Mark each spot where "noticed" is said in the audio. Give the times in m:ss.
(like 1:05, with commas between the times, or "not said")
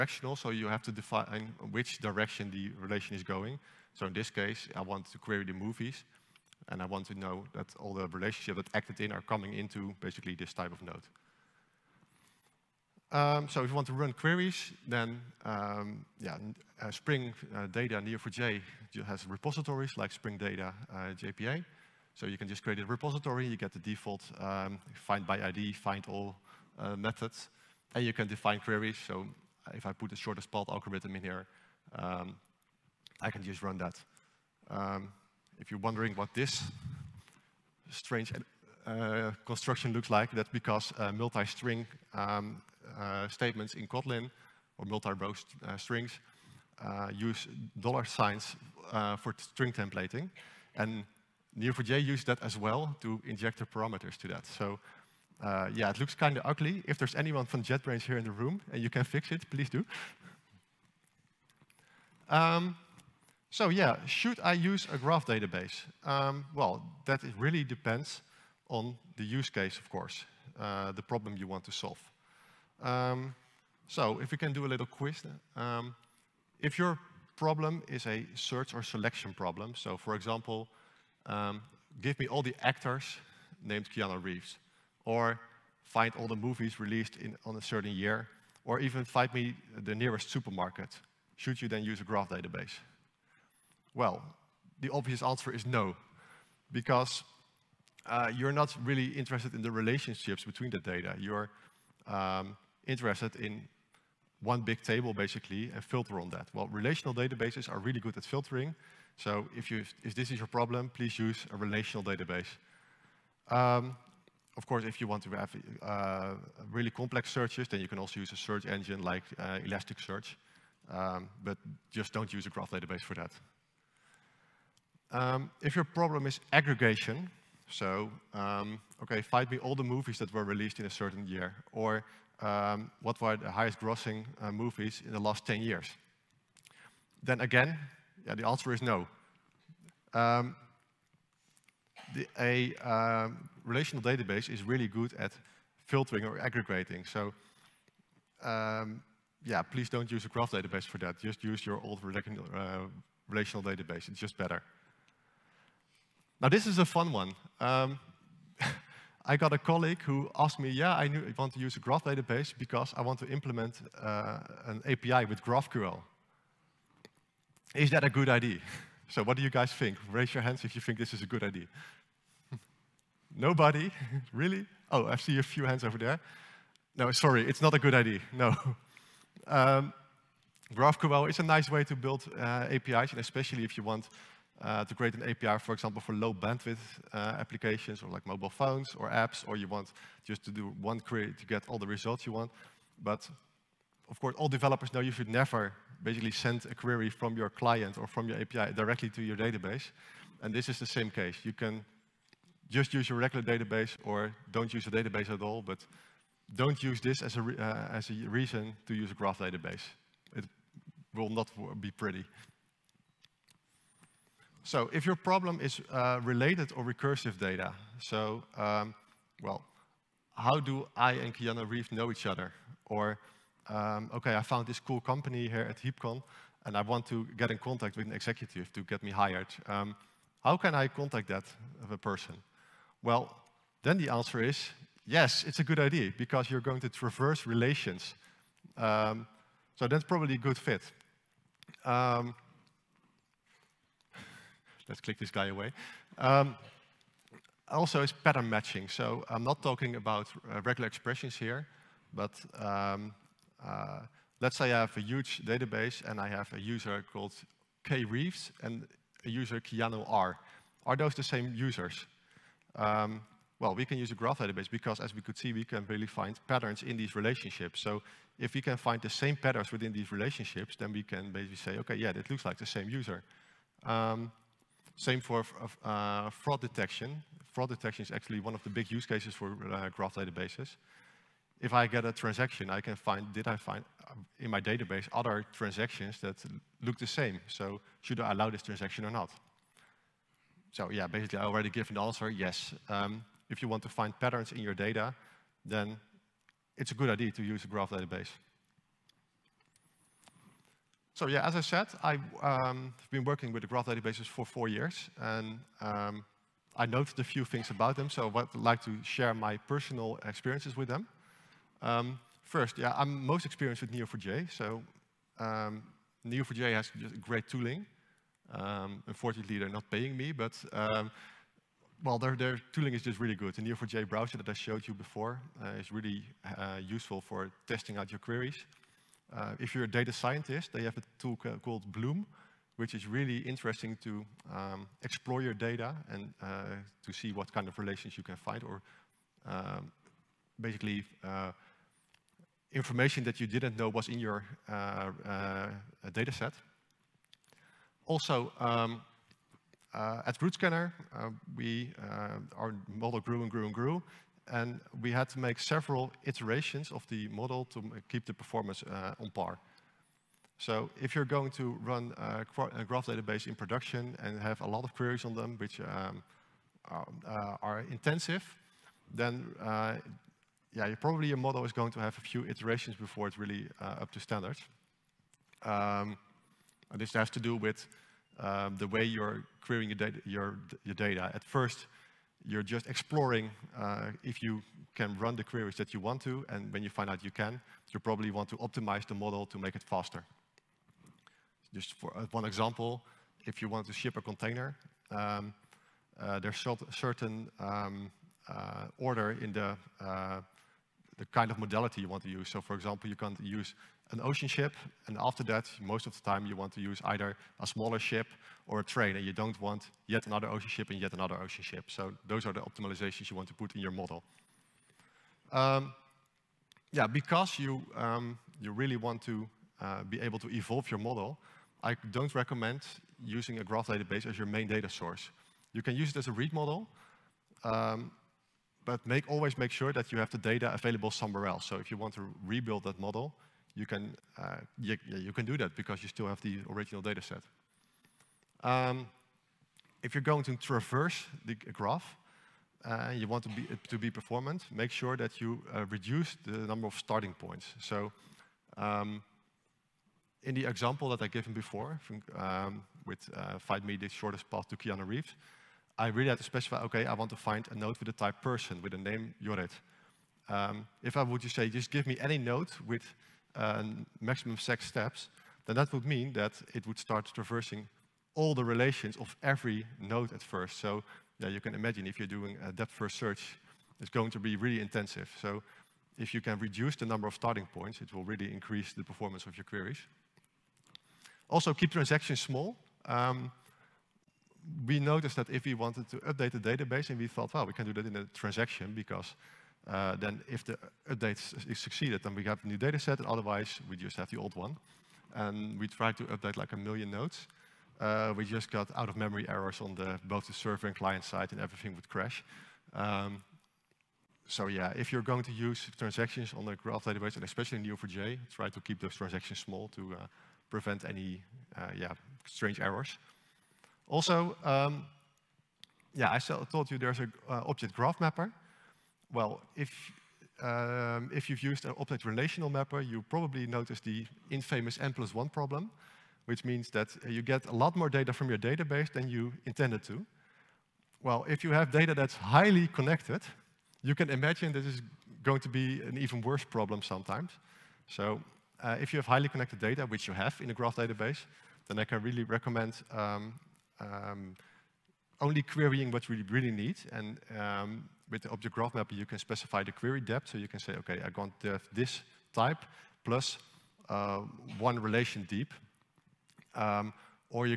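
8:04, 8:43.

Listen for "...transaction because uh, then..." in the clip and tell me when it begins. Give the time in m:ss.
8:08.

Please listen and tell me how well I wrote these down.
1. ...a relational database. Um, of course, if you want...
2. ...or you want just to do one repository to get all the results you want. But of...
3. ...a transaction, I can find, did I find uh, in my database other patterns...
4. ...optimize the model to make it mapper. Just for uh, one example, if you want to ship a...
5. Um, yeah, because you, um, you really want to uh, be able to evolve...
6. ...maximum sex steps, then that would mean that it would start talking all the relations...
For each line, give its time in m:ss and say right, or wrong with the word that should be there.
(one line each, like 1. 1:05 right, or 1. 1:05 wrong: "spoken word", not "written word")
1. 1:51 right
2. 3:09 wrong: "query", not "repository"
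3. 4:42 wrong: "transactions", not "patterns"
4. 6:28 wrong: "faster", not "mapper"
5. 6:55 right
6. 7:44 wrong: "traversing", not "talking".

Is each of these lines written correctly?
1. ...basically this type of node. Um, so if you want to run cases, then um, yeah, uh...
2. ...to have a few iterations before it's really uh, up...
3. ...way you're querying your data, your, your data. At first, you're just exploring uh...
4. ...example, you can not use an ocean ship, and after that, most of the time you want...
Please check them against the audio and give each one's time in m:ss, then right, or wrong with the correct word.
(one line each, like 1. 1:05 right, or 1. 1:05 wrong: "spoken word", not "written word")
1. 0:09 wrong: "queries", not "cases"
2. 6:11 right
3. 6:18 right
4. 6:42 right.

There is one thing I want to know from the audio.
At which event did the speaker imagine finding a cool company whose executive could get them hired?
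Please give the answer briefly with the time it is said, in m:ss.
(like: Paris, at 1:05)
HeapCon, at 3:45.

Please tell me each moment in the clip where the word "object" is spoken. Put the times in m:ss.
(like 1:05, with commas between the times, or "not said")
8:37, 8:41, 9:08.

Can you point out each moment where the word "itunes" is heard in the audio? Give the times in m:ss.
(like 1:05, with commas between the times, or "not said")
not said.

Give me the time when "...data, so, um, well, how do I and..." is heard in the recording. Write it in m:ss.
3:37.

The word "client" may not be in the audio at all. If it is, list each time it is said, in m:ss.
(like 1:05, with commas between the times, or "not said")
3:17, 8:20.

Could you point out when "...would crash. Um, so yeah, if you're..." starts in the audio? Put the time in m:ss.
8:21.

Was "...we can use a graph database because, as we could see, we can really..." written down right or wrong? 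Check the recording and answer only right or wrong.
right.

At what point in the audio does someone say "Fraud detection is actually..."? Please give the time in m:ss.
4:37.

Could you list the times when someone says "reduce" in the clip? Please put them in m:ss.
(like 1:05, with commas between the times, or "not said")
7:25, 7:56.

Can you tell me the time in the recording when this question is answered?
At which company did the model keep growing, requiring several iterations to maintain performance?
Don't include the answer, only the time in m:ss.
5:50.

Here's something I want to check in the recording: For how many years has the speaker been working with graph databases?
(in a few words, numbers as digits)
4.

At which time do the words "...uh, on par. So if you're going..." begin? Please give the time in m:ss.
5:58.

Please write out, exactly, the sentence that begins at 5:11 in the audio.
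Um, first, yeah, I'm most experienced with Neo4j, so um, Neo4j has great tooling.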